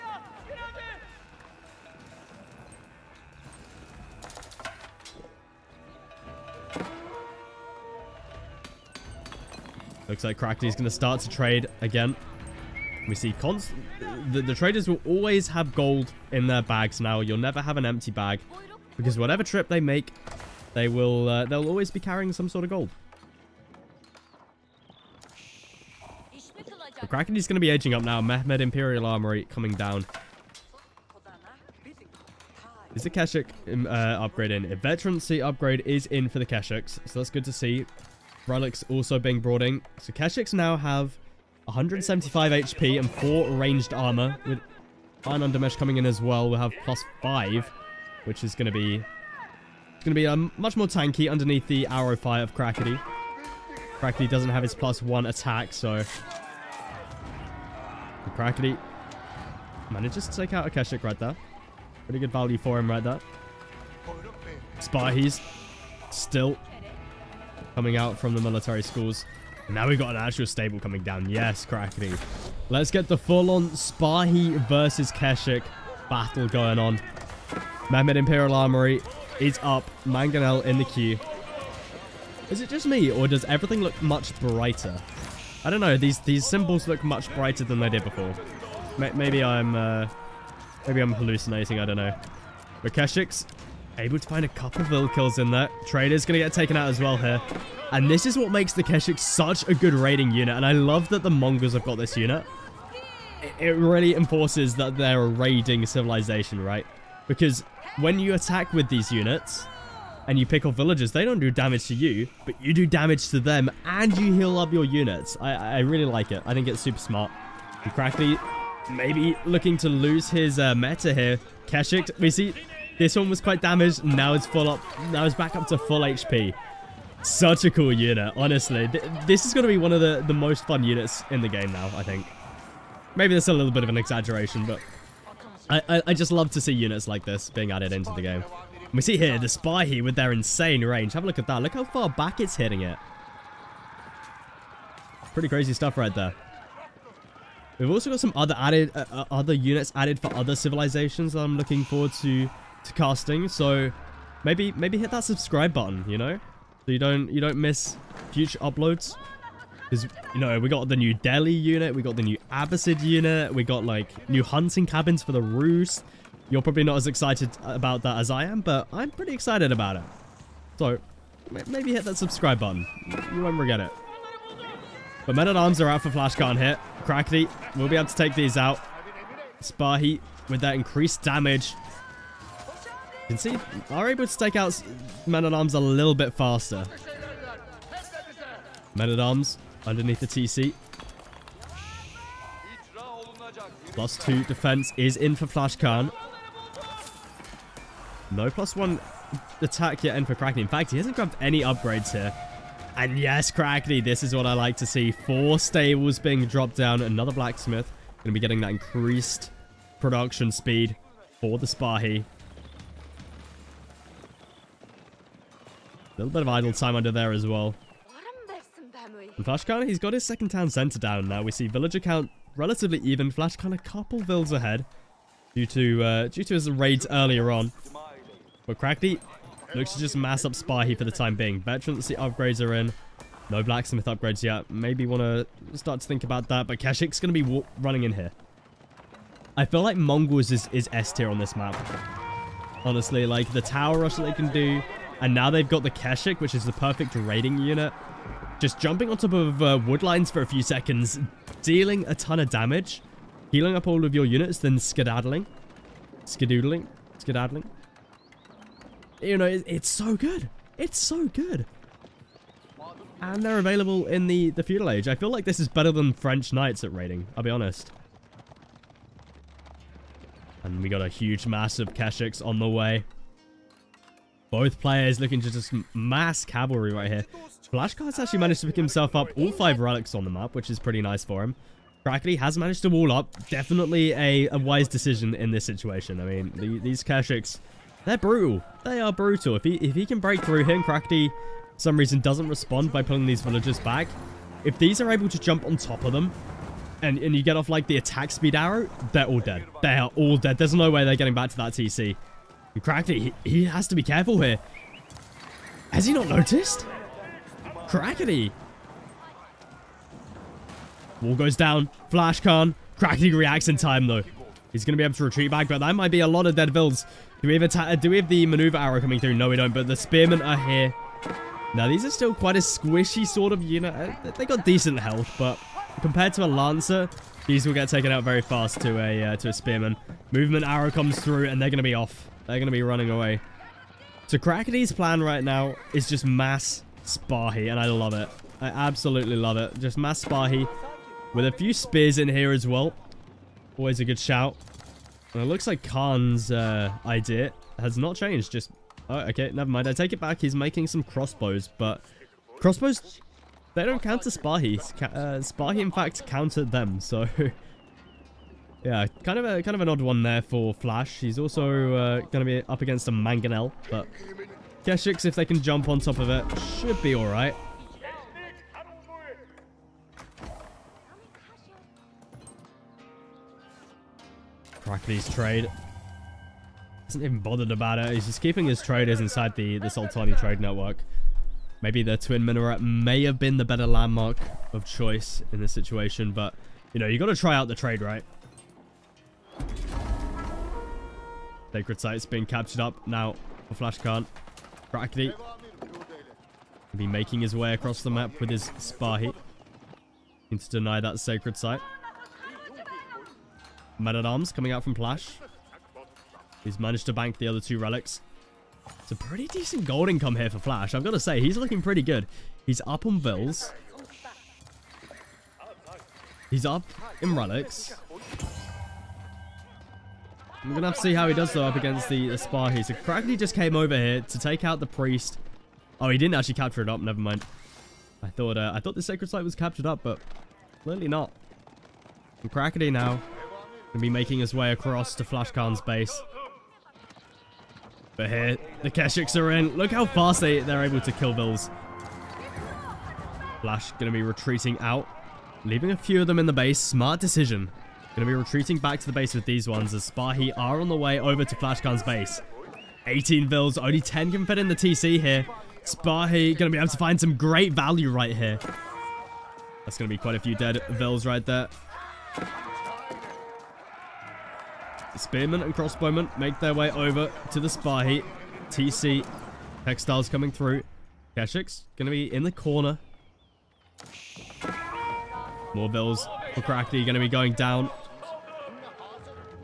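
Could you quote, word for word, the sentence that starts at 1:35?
Trader's going to get taken out as well here.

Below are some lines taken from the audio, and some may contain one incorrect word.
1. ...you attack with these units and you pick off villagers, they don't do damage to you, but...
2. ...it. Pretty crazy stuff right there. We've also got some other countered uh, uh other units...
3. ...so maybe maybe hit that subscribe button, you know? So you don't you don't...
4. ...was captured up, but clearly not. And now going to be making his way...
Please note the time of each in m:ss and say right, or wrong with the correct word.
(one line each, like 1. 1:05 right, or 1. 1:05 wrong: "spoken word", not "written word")
1. 1:48 right
2. 2:22 wrong: "added", not "countered"
3. 2:33 right
4. 7:09 right.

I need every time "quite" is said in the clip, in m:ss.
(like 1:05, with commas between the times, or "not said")
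2:03, 5:22, 7:40.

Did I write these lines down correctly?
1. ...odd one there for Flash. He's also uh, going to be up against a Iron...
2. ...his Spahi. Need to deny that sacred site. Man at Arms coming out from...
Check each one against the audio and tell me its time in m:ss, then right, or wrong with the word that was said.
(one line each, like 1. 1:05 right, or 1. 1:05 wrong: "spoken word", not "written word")
1. 5:59 wrong: "Mangonel", not "Iron"
2. 6:38 right.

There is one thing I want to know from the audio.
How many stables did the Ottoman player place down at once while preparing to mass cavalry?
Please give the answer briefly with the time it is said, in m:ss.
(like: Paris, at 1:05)
4, at 3:25.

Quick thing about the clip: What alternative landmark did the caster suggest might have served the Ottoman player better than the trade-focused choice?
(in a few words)
Twin Minaret.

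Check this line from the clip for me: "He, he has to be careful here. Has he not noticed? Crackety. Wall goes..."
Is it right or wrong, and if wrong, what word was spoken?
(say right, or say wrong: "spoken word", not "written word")
right.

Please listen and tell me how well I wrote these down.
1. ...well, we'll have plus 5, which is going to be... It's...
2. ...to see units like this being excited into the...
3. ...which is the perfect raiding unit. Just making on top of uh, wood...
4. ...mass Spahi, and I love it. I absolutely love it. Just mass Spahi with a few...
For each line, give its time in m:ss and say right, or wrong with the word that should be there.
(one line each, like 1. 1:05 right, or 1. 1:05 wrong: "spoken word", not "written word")
1. 0:46 right
2. 2:16 wrong: "added", not "excited"
3. 4:06 wrong: "jumping", not "making"
4. 5:36 right.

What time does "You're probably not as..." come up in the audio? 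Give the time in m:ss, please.
2:46.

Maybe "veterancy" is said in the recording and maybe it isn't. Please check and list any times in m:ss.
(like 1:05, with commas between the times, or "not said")
0:34, 3:51.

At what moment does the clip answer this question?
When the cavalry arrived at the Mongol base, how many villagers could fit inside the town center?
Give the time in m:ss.
7:33.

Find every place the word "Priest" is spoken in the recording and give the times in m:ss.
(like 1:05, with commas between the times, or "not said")
7:04.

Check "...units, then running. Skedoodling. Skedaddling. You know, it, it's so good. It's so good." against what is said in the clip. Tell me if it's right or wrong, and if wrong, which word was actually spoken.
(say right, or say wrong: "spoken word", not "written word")
wrong: "skedaddling", not "running".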